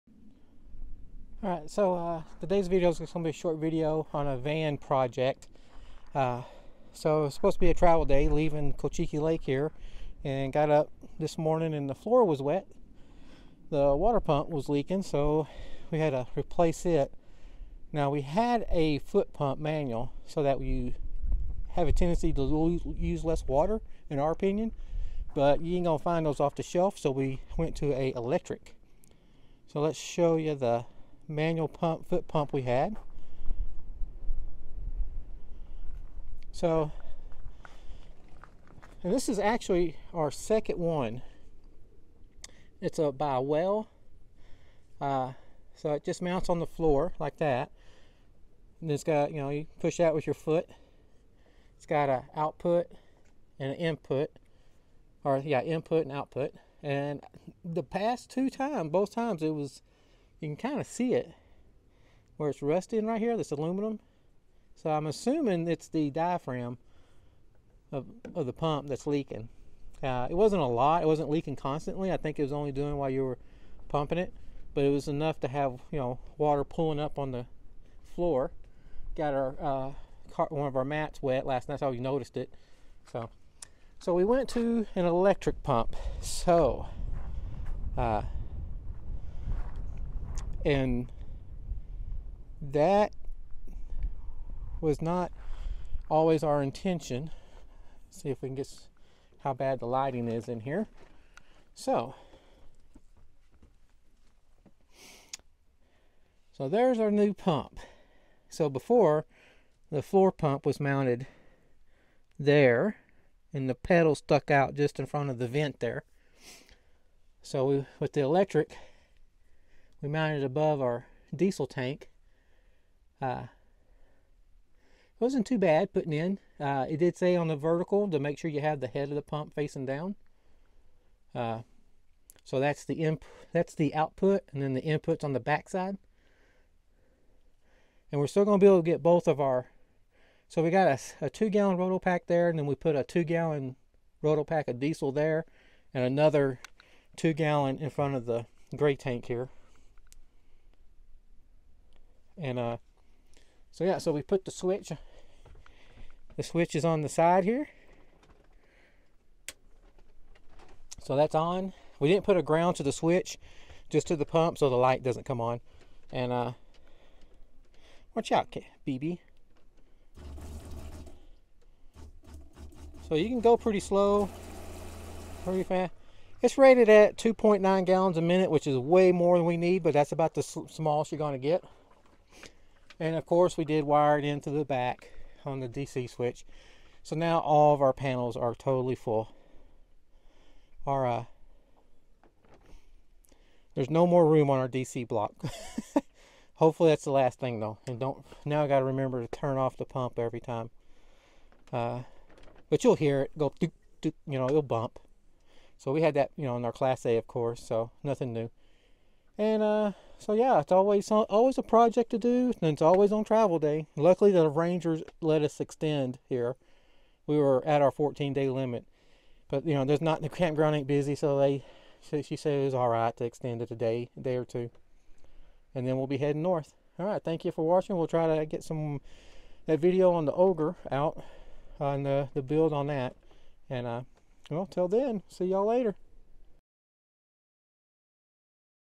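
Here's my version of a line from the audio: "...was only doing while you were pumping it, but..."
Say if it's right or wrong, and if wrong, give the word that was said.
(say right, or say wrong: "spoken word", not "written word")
right.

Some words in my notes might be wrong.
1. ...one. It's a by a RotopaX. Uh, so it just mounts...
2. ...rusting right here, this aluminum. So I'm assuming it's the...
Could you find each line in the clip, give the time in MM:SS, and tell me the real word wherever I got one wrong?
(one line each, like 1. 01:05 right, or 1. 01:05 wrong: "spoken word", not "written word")
1. 00:40 wrong: "Whale", not "RotopaX"
2. 01:02 right.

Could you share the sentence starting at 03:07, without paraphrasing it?
So now all of our panels are totally full.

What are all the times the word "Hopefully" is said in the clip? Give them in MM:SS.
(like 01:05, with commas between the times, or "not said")
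03:16.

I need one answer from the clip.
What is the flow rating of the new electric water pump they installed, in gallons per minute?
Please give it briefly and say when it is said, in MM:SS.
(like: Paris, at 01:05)
2.9, at 02:57.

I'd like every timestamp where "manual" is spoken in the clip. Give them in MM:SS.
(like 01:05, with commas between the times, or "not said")
00:19, 00:31.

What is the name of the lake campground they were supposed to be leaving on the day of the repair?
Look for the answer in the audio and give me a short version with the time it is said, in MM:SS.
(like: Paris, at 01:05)
Cochiti Lake, at 00:08.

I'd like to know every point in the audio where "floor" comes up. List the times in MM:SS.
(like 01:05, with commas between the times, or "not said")
00:11, 00:46, 01:18, 01:50.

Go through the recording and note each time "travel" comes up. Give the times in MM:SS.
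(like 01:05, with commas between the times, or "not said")
00:07, 03:33.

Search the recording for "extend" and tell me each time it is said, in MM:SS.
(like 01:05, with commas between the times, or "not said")
03:35, 03:43.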